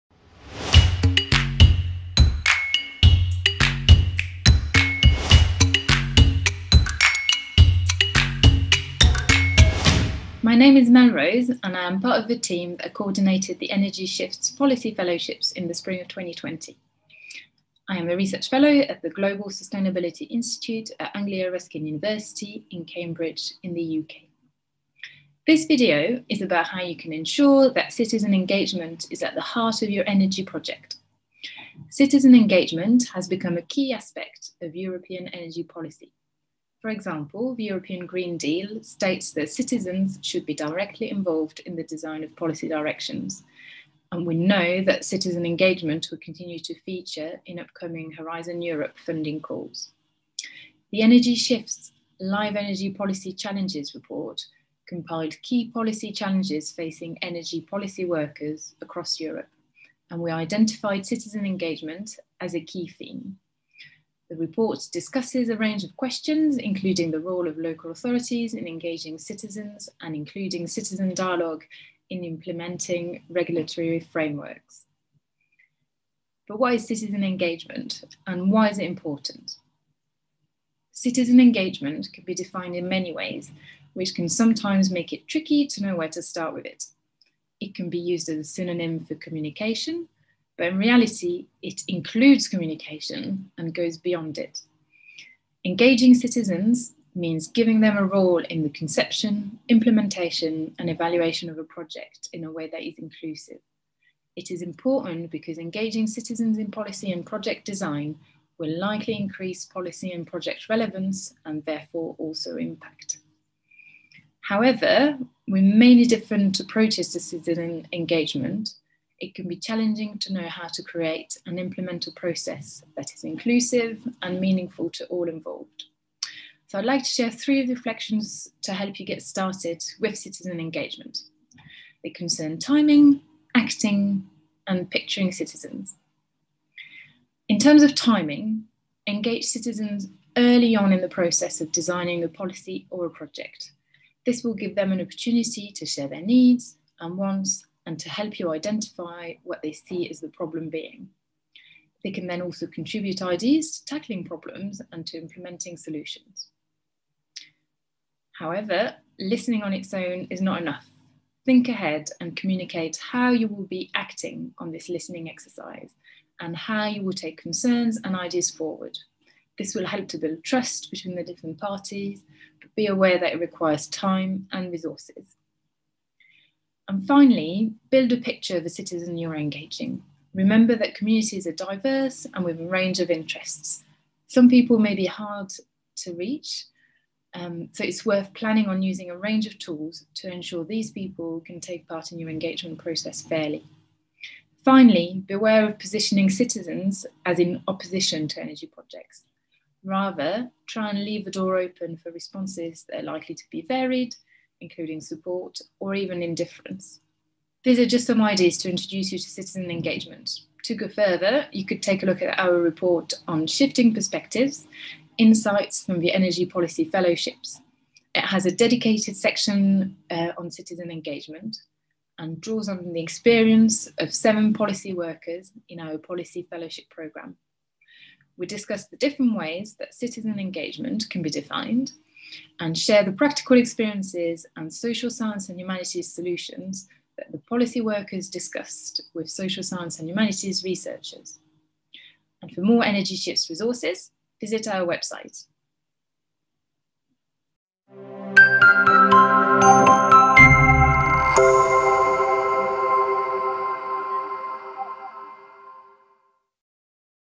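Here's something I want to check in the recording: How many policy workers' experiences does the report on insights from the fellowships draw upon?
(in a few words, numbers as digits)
7.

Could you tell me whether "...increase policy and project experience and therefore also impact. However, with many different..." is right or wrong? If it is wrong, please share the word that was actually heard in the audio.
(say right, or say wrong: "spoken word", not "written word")
wrong: "relevance", not "experience".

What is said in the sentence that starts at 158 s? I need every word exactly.
However, listening on its own is not enough.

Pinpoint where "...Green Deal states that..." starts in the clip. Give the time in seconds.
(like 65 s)
38 s.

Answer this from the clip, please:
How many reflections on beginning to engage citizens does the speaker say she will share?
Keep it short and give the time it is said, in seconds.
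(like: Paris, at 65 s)
3, at 127 s.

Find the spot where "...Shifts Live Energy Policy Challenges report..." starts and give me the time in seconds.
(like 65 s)
51 s.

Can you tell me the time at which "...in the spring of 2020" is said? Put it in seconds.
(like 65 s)
15 s.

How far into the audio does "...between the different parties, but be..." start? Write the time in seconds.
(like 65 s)
170 s.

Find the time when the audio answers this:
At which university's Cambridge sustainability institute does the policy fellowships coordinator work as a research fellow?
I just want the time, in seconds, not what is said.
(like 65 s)
21 s.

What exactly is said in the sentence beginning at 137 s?
In terms of timing, engage citizens early on in the process of designing a policy or a project.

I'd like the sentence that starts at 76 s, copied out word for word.
But why is citizen engagement and why is it important?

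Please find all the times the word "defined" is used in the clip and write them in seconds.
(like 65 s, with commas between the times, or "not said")
82 s, 231 s.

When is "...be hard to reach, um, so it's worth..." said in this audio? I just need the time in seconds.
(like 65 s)
184 s.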